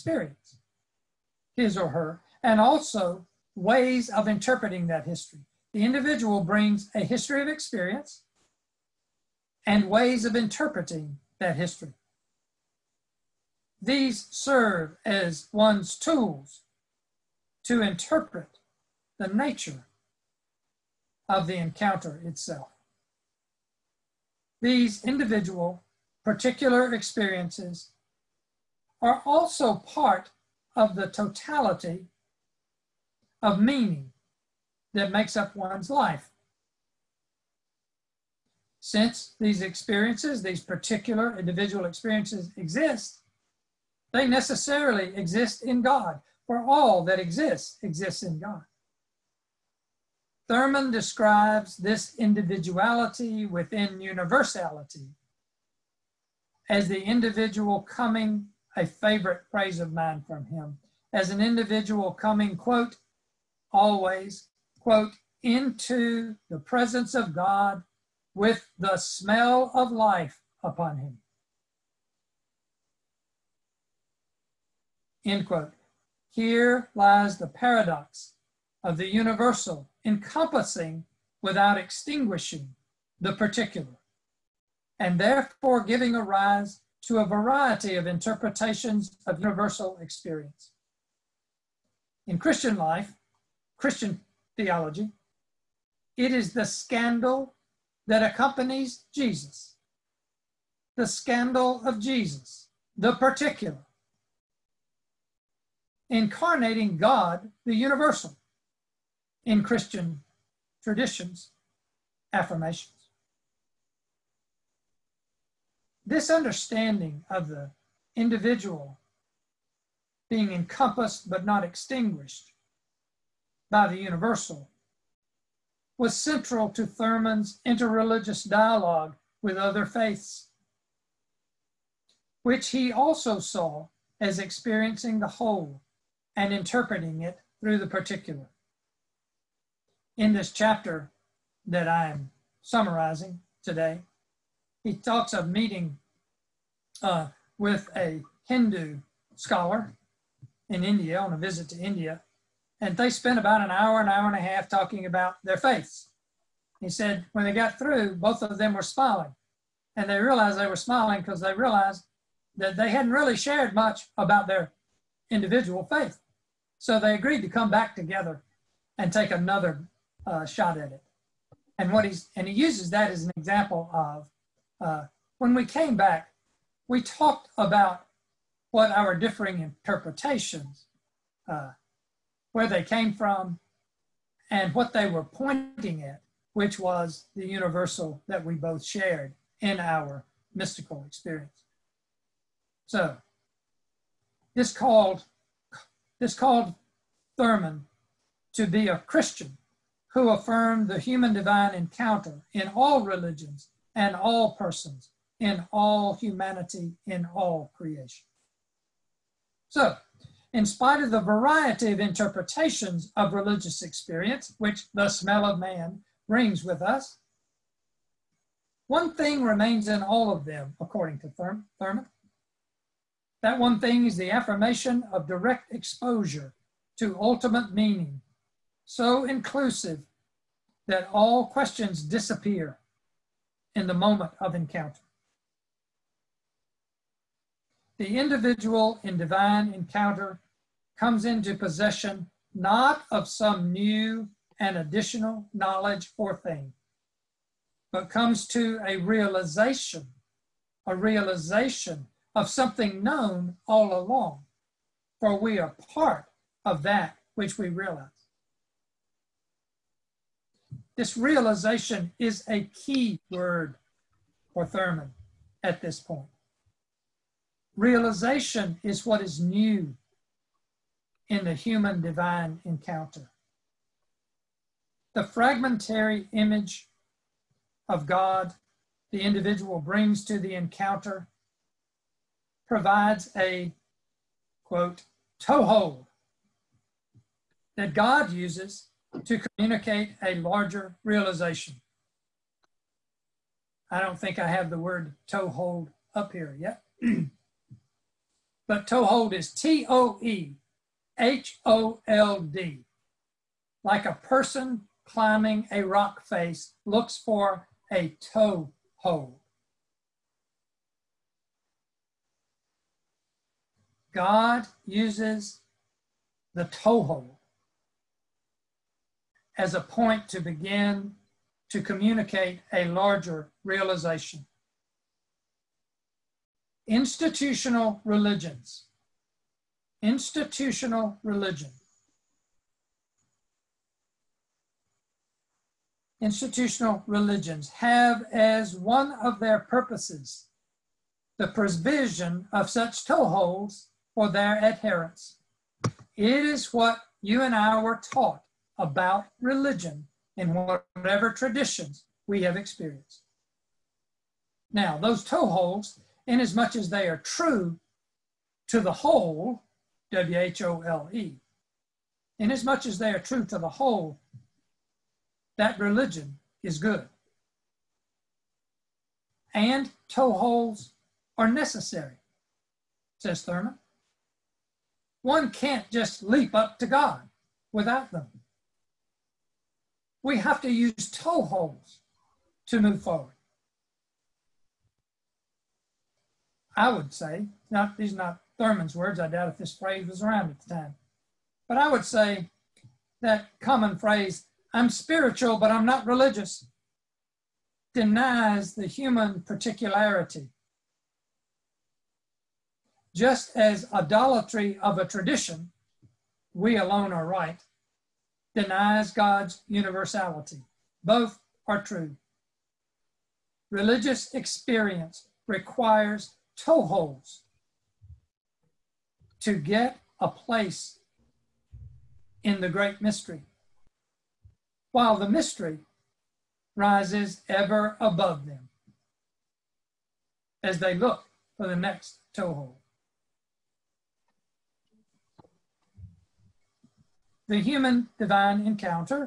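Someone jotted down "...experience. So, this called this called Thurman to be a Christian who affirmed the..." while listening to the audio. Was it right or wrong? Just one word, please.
right.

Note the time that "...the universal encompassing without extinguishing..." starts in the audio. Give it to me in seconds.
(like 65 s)
78 s.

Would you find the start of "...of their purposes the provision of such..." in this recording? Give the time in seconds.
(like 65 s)
339 s.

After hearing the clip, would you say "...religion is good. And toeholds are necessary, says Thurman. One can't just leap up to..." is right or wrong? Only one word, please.
right.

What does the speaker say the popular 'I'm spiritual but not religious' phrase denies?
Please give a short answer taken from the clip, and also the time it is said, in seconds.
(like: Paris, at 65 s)
human particularity, at 398 s.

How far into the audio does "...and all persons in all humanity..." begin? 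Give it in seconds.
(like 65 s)
203 s.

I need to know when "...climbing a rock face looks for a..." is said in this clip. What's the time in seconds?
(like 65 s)
305 s.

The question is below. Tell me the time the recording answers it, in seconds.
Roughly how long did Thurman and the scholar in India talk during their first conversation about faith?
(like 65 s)
153 s.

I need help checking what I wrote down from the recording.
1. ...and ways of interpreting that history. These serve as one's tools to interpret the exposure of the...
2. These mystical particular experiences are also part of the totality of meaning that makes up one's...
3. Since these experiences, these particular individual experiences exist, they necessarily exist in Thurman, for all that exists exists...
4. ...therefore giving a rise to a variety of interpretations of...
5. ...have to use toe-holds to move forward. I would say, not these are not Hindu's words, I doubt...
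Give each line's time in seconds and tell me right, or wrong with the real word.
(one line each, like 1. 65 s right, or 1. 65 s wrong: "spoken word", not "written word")
1. 9 s wrong: "nature", not "exposure"
2. 24 s wrong: "individual", not "mystical"
3. 38 s wrong: "God", not "Thurman"
4. 85 s right
5. 380 s wrong: "Thurman", not "Hindu".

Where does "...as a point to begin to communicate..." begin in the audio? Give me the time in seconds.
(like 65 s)
319 s.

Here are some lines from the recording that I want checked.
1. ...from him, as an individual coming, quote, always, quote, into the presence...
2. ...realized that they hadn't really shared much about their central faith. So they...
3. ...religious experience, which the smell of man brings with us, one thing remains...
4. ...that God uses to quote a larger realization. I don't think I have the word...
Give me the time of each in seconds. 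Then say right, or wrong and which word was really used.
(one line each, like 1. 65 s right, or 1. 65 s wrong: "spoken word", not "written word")
1. 60 s right
2. 161 s wrong: "individual", not "central"
3. 213 s right
4. 287 s wrong: "communicate", not "quote".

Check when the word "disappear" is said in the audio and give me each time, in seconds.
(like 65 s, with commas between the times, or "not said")
232 s.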